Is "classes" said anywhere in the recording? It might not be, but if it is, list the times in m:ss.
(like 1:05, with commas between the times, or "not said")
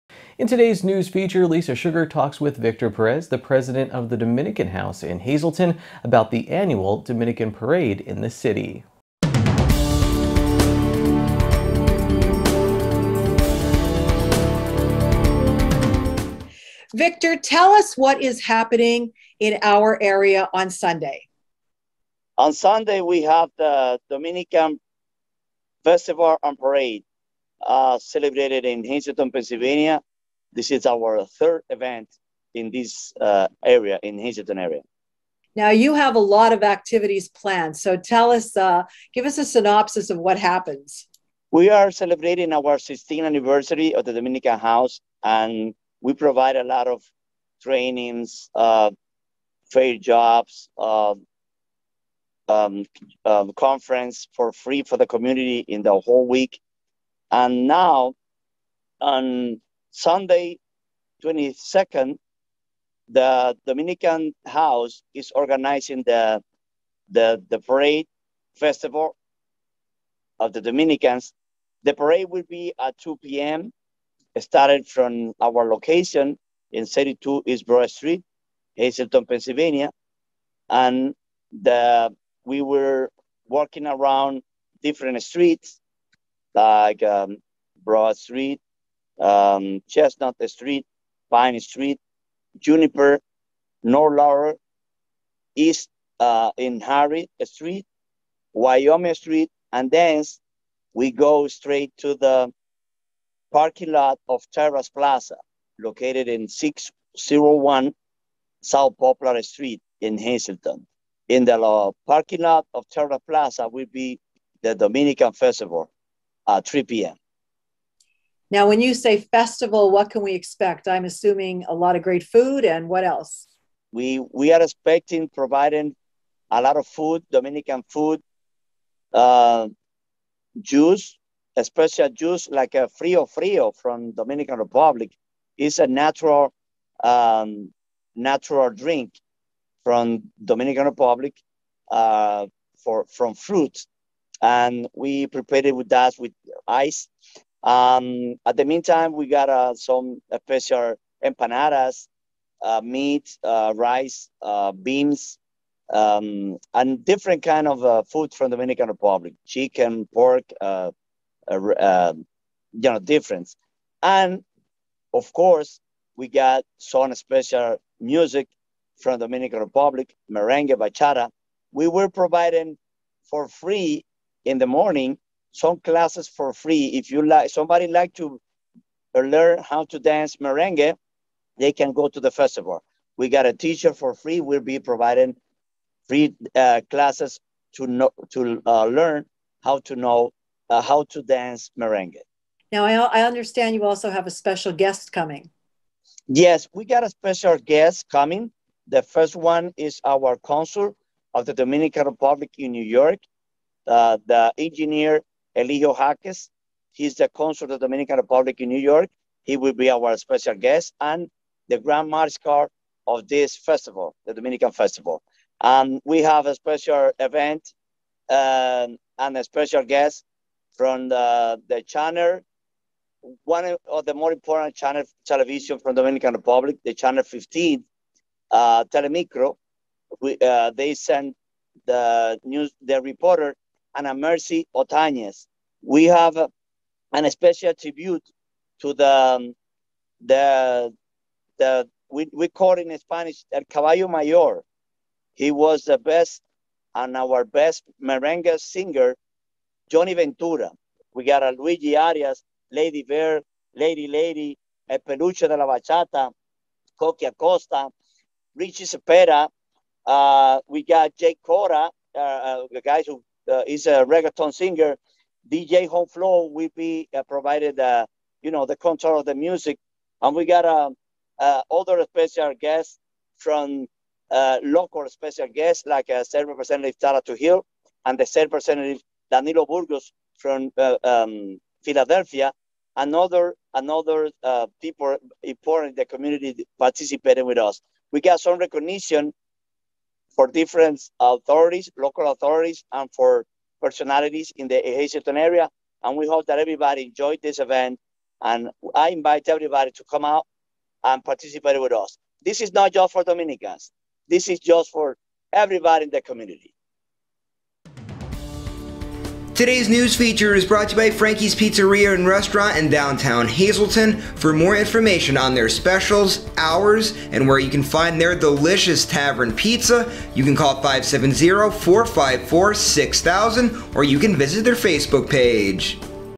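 2:55, 3:06.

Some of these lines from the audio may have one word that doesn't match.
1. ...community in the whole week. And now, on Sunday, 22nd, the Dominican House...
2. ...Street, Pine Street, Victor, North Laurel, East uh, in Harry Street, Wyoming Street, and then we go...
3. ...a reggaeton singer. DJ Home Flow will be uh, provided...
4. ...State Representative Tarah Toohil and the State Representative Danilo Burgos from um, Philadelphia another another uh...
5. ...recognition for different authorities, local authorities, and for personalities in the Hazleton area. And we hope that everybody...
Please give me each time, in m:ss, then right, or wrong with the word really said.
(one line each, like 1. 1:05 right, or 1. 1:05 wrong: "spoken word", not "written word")
1. 0:55 right
2. 1:30 wrong: "Juniper", not "Victor"
3. 4:23 right
4. 4:36 right
5. 4:48 right.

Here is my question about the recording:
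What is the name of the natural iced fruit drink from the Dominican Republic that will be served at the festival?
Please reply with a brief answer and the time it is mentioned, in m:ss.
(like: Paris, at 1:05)
Frio Frio, at 2:12.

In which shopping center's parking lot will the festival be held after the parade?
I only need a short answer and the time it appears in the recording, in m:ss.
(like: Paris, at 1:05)
Terrace Plaza, at 1:44.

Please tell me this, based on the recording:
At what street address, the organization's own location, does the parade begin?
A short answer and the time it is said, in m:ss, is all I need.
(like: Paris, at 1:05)
32 East Broad Street, at 1:16.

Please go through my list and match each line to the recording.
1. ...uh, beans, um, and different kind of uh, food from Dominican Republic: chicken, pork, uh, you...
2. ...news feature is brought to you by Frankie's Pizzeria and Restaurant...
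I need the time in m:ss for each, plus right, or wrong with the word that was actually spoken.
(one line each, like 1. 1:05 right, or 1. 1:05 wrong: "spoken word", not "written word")
1. 2:34 right
2. 5:09 right.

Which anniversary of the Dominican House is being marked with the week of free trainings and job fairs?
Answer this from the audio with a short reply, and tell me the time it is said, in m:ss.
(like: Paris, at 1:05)
16th, at 0:42.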